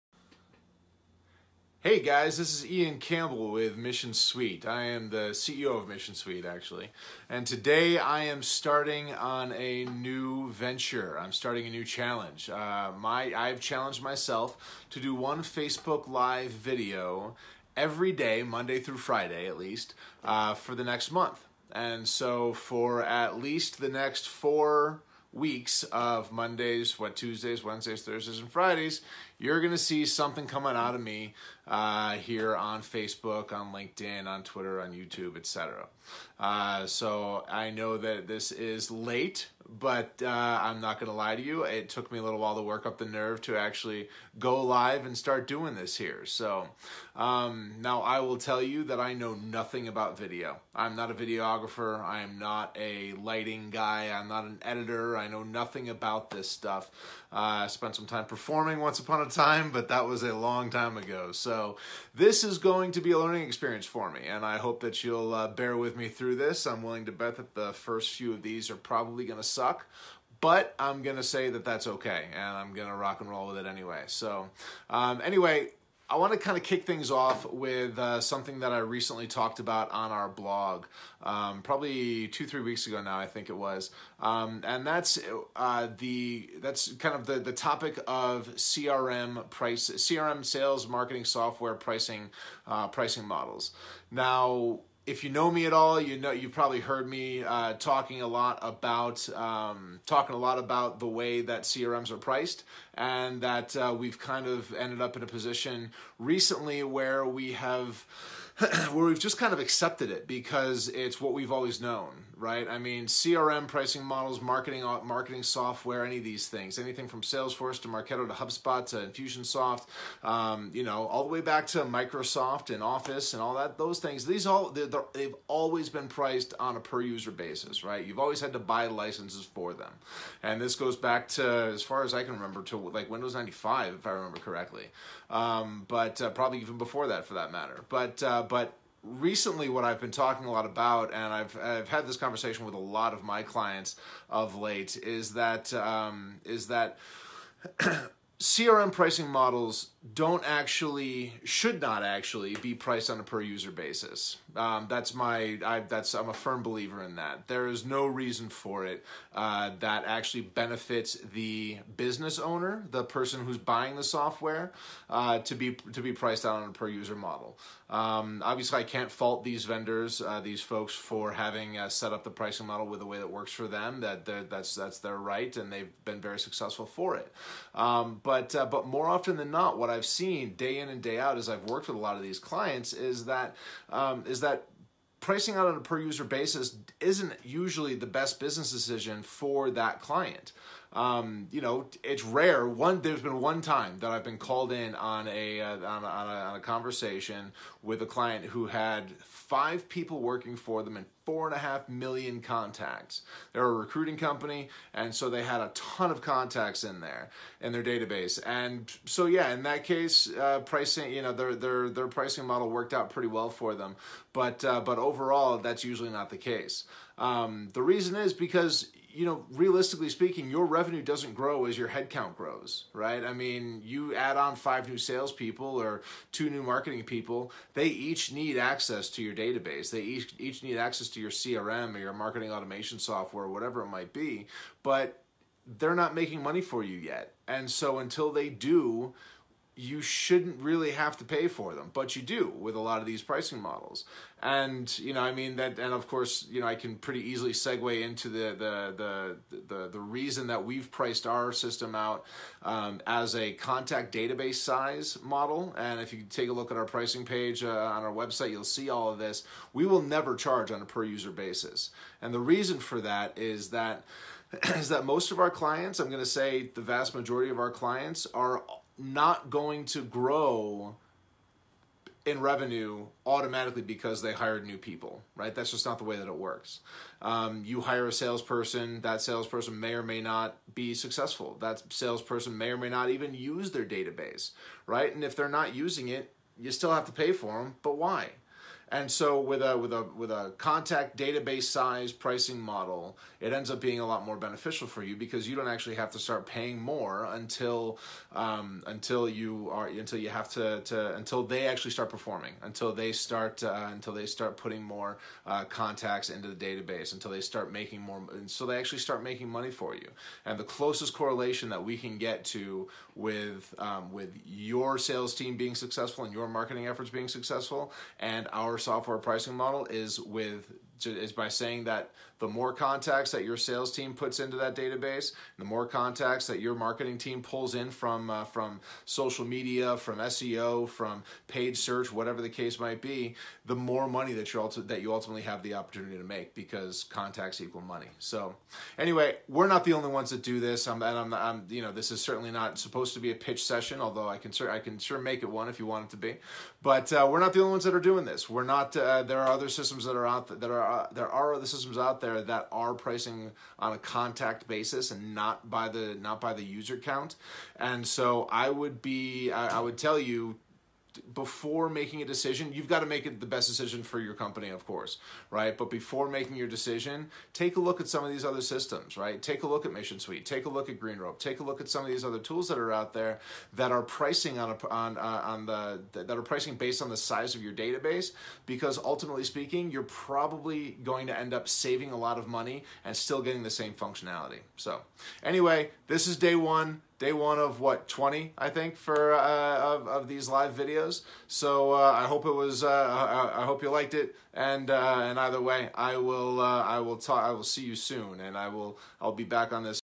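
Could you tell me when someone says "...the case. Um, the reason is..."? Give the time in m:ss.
3:36.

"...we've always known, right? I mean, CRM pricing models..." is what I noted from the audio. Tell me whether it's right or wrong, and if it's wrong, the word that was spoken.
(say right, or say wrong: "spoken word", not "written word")
right.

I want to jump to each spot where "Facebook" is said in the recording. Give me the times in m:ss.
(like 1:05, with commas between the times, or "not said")
0:15, 0:32.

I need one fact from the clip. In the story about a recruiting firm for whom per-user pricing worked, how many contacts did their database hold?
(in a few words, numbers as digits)
4.5 million.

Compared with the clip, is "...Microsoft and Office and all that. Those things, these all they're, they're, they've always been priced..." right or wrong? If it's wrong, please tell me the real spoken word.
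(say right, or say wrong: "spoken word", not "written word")
right.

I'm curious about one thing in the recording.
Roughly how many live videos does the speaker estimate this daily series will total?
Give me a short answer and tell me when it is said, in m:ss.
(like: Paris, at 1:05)
20, at 6:28.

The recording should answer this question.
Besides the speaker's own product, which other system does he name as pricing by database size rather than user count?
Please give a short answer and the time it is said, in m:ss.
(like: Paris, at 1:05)
GreenRope, at 6:10.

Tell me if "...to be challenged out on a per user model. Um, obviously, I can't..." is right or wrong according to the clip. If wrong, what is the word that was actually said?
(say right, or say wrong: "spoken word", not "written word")
wrong: "priced", not "challenged".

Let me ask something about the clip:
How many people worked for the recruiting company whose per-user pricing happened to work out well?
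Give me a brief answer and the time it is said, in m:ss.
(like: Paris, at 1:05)
5, at 3:19.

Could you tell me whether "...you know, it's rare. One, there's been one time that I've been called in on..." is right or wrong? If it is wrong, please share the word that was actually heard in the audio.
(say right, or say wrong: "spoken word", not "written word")
right.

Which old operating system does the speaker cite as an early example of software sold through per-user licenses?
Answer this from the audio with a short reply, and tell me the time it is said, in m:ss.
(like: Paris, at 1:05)
Windows 95, at 2:13.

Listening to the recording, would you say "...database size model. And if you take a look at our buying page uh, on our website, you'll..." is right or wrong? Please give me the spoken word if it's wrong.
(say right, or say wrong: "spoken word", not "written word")
wrong: "pricing", not "buying".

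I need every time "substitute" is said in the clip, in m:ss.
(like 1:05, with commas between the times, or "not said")
not said.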